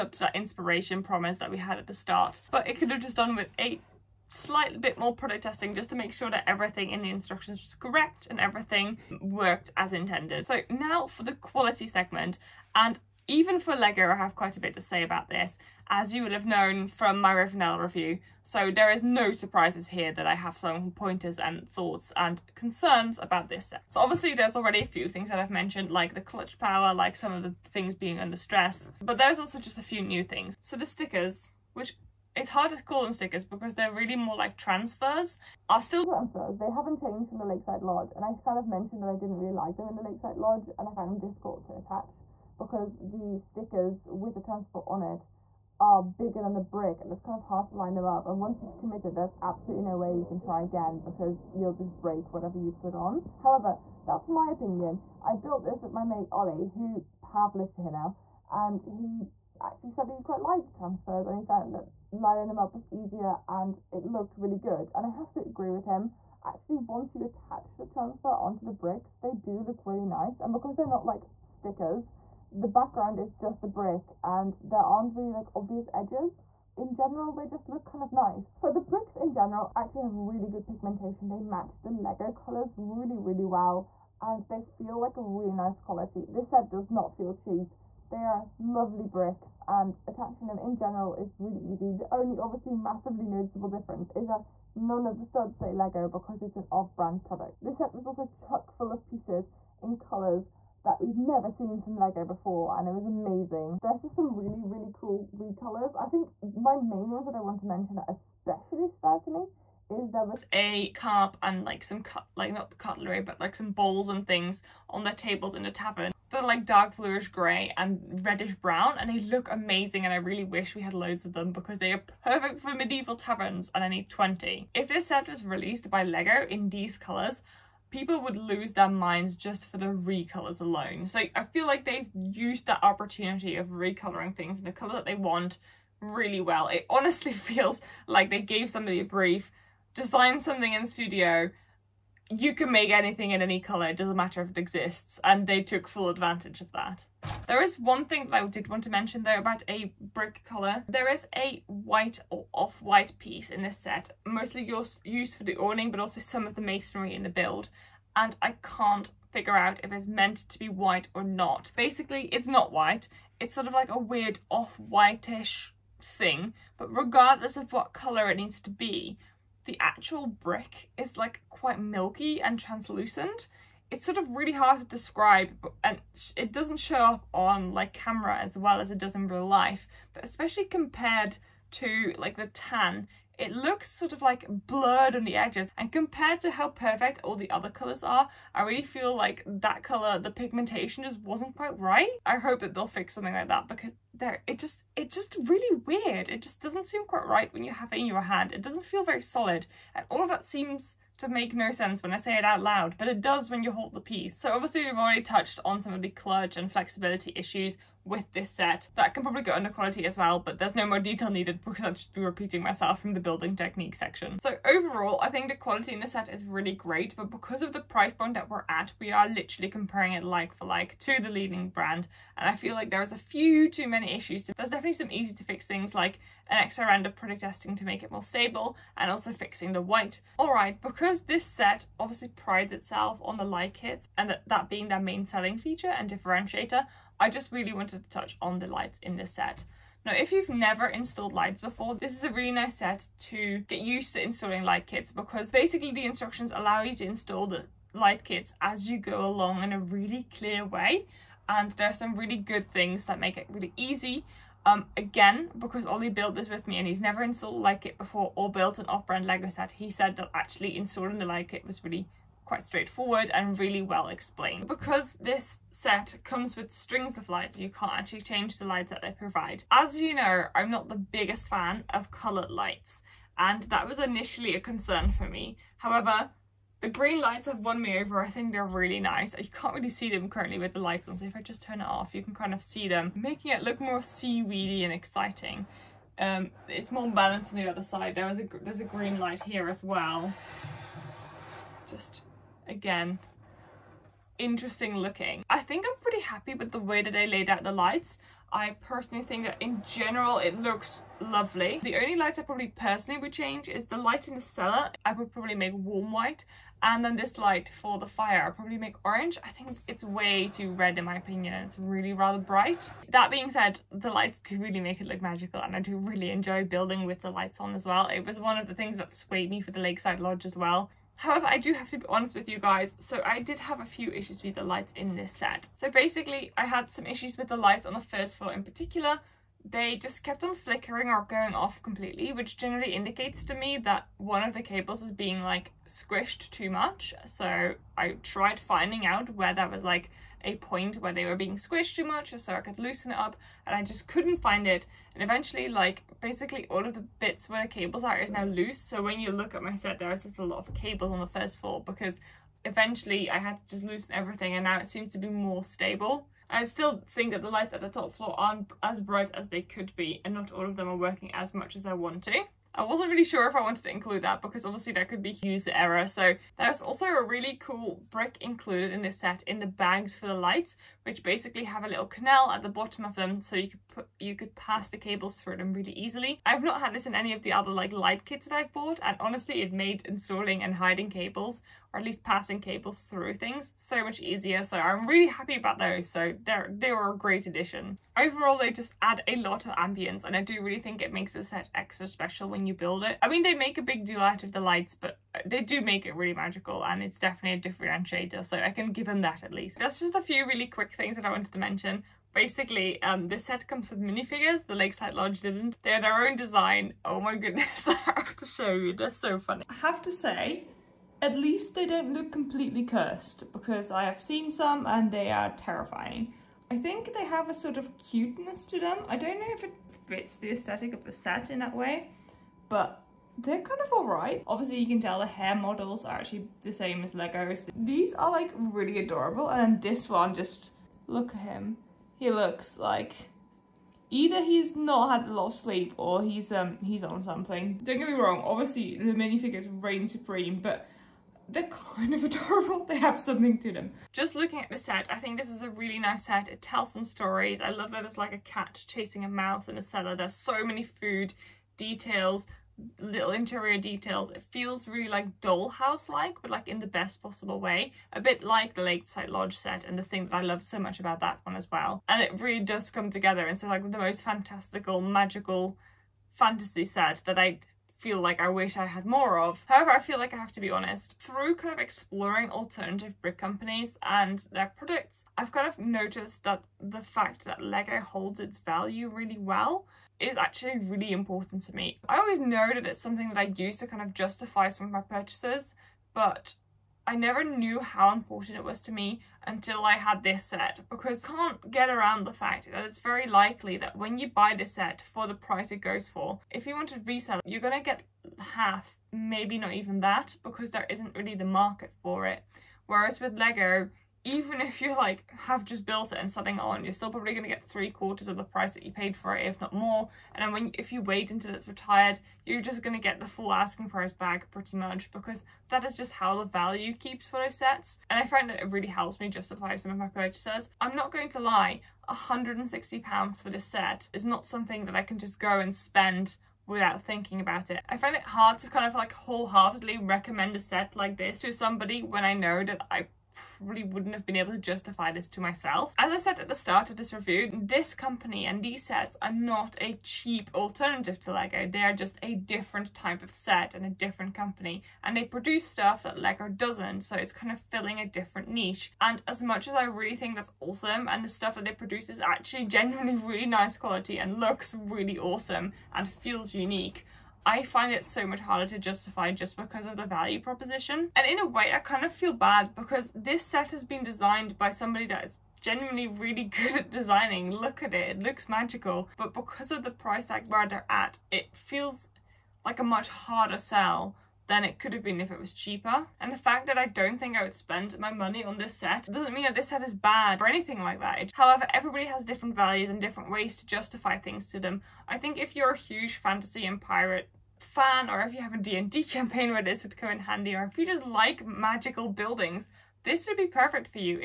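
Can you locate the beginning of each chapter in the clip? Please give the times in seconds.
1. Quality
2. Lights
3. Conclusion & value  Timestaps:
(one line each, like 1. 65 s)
1. 10 s
2. 230 s
3. 444 s.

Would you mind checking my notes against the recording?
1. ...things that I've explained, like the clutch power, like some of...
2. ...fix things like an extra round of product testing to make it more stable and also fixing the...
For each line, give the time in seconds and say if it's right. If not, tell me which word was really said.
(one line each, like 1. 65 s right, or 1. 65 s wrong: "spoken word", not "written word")
1. 25 s wrong: "mentioned", not "explained"
2. 225 s right.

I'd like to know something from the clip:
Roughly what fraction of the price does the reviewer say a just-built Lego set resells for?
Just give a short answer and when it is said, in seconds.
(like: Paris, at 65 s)
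three quarters, at 507 s.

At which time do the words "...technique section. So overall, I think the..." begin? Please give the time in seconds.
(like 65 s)
213 s.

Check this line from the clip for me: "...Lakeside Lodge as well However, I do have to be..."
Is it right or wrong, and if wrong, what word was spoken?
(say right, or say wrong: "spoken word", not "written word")
right.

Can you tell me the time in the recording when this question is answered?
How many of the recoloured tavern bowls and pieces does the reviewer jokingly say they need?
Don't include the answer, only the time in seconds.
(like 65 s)
124 s.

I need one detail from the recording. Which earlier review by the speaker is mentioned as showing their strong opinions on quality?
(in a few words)
Rivendell.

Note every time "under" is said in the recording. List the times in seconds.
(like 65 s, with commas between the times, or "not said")
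28 s, 209 s.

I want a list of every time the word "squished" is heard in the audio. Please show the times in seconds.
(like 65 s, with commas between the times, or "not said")
335 s, 341 s.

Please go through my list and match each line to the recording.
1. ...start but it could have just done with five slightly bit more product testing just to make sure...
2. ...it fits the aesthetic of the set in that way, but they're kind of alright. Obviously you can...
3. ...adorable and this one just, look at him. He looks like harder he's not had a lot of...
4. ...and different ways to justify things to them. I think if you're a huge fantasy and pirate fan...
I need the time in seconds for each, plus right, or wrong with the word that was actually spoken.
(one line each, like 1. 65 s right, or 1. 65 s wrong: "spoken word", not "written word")
1. 1 s wrong: "eight", not "five"
2. 419 s right
3. 428 s wrong: "either", not "harder"
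4. 582 s right.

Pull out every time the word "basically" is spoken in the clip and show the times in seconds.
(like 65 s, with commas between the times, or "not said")
161 s, 245 s, 325 s, 346 s, 371 s, 402 s.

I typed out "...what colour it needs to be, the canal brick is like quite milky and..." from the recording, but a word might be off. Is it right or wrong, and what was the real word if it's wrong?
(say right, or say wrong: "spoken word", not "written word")
wrong: "actual", not "canal".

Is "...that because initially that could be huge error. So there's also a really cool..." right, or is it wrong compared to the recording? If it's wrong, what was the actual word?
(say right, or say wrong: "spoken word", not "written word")
wrong: "obviously", not "initially".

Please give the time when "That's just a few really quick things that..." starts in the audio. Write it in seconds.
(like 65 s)
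399 s.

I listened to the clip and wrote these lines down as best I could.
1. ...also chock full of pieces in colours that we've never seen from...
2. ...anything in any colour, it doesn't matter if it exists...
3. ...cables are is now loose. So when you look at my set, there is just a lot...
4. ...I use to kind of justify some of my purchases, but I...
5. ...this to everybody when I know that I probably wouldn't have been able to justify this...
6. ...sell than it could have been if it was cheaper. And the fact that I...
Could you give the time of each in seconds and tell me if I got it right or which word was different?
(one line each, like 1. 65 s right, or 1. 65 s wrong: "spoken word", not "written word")
1. 98 s right
2. 142 s right
3. 347 s right
4. 483 s right
5. 531 s wrong: "somebody", not "everybody"
6. 573 s right.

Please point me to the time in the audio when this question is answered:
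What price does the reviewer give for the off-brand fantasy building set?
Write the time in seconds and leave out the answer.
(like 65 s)
522 s.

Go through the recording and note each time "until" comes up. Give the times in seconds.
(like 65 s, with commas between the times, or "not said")
489 s, 511 s.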